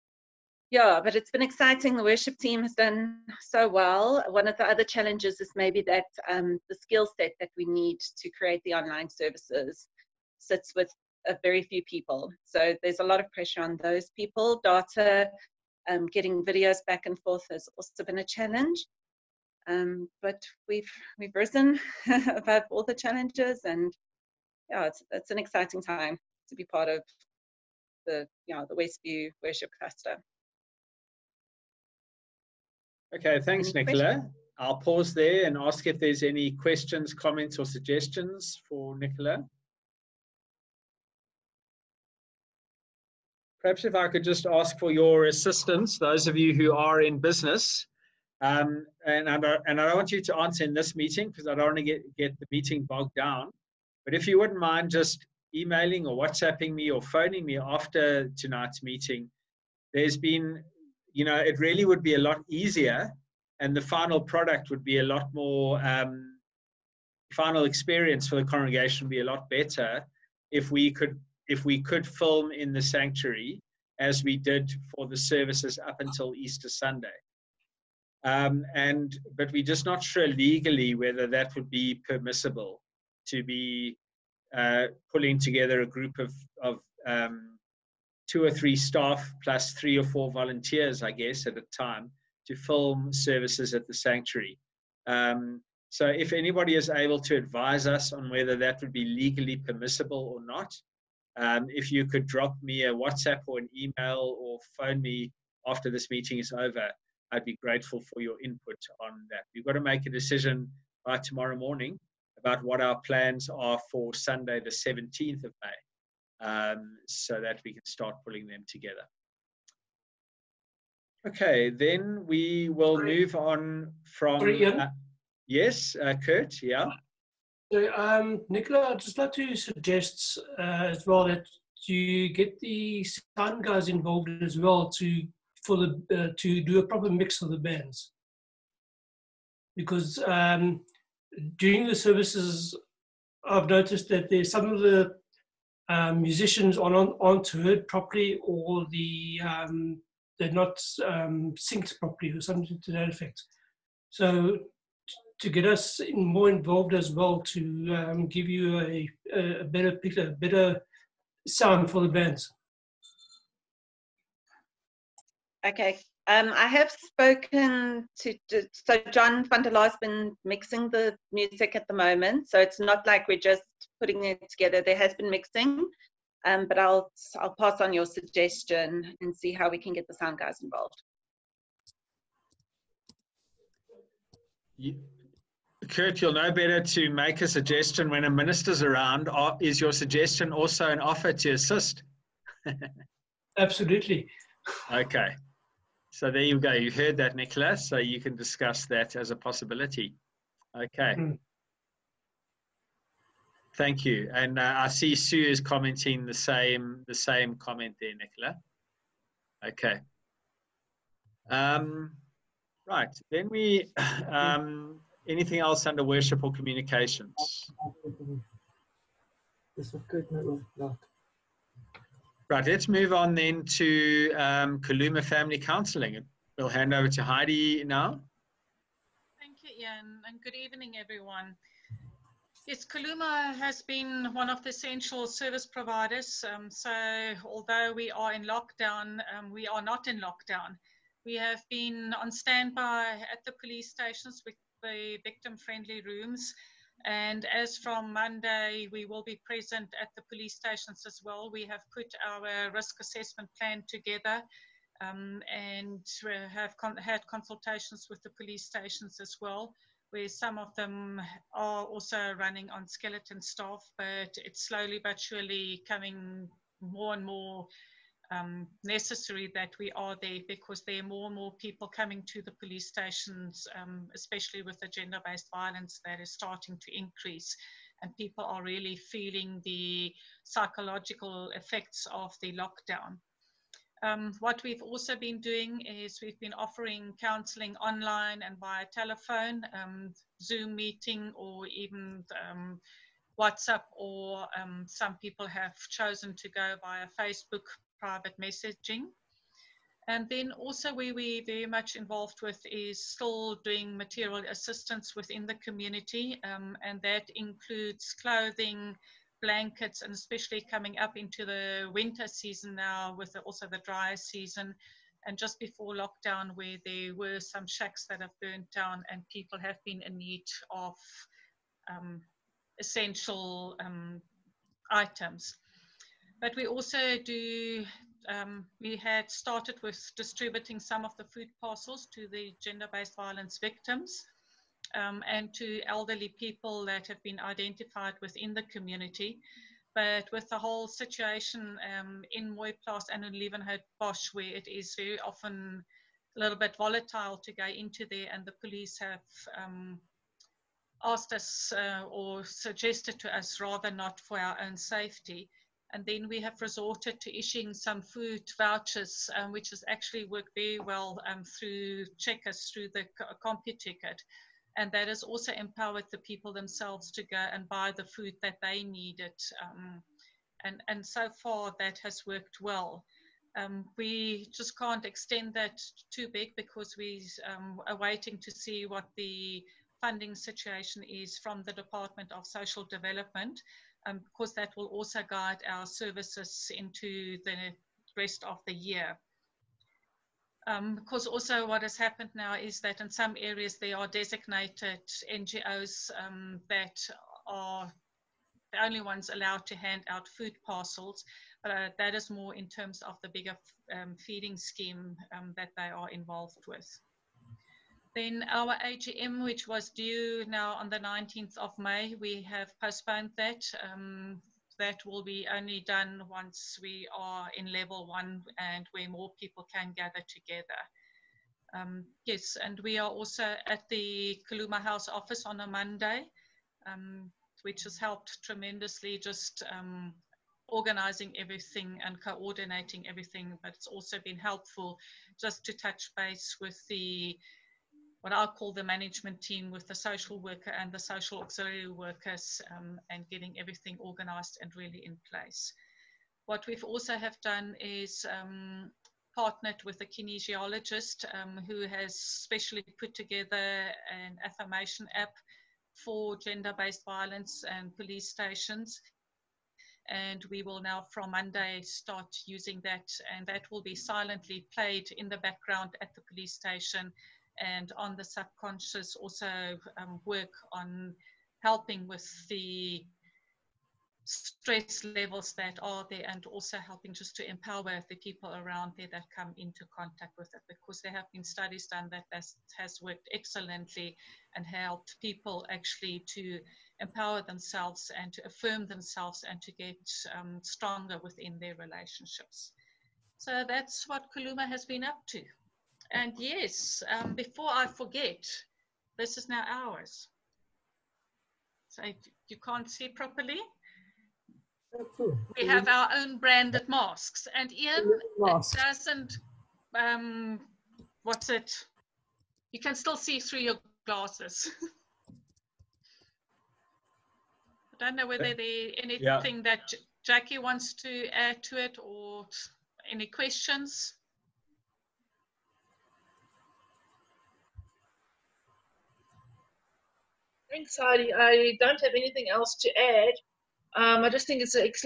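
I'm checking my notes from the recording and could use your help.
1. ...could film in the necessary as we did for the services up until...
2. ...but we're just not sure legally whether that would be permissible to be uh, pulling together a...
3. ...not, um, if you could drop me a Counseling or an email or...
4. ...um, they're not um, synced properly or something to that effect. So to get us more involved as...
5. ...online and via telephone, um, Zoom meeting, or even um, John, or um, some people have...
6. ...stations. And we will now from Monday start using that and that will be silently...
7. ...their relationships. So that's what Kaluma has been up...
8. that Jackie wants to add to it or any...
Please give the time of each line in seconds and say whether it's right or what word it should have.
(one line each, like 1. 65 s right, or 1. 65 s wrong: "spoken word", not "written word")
1. 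71 s wrong: "sanctuary", not "necessary"
2. 79 s right
3. 100 s wrong: "WhatsApp", not "Counseling"
4. 149 s right
5. 287 s wrong: "WhatsApp", not "John"
6. 458 s right
7. 491 s right
8. 519 s right.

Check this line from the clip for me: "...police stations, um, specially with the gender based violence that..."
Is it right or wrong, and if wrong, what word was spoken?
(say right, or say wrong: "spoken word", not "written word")
wrong: "especially", not "specially".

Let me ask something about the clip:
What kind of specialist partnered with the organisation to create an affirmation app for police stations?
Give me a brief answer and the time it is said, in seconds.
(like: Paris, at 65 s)
Kinesiologist, at 450 s.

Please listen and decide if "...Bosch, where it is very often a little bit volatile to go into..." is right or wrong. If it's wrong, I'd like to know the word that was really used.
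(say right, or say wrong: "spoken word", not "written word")
right.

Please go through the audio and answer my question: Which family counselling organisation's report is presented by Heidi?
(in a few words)
Kaluma Family Counseling.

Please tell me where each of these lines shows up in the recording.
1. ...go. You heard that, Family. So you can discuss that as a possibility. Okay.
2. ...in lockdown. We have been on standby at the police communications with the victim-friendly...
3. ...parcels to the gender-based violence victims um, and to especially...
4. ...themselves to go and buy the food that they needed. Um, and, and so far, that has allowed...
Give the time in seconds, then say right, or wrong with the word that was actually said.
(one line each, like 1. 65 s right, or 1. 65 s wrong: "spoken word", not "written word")
1. 196 s wrong: "Nicholas", not "Family"
2. 240 s wrong: "stations", not "communications"
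3. 331 s wrong: "elderly", not "especially"
4. 366 s wrong: "worked", not "allowed".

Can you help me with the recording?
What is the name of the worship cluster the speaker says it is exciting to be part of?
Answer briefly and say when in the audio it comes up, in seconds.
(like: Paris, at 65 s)
Westview Worship Cluster, at 28 s.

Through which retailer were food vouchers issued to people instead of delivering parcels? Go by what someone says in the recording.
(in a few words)
Checkers.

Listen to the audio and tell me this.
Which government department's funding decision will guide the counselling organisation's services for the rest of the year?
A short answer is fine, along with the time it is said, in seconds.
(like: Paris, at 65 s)
Department of Social Development, at 381 s.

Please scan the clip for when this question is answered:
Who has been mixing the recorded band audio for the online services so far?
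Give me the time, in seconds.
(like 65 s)
169 s.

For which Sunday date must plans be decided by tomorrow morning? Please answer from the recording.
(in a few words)
17 May.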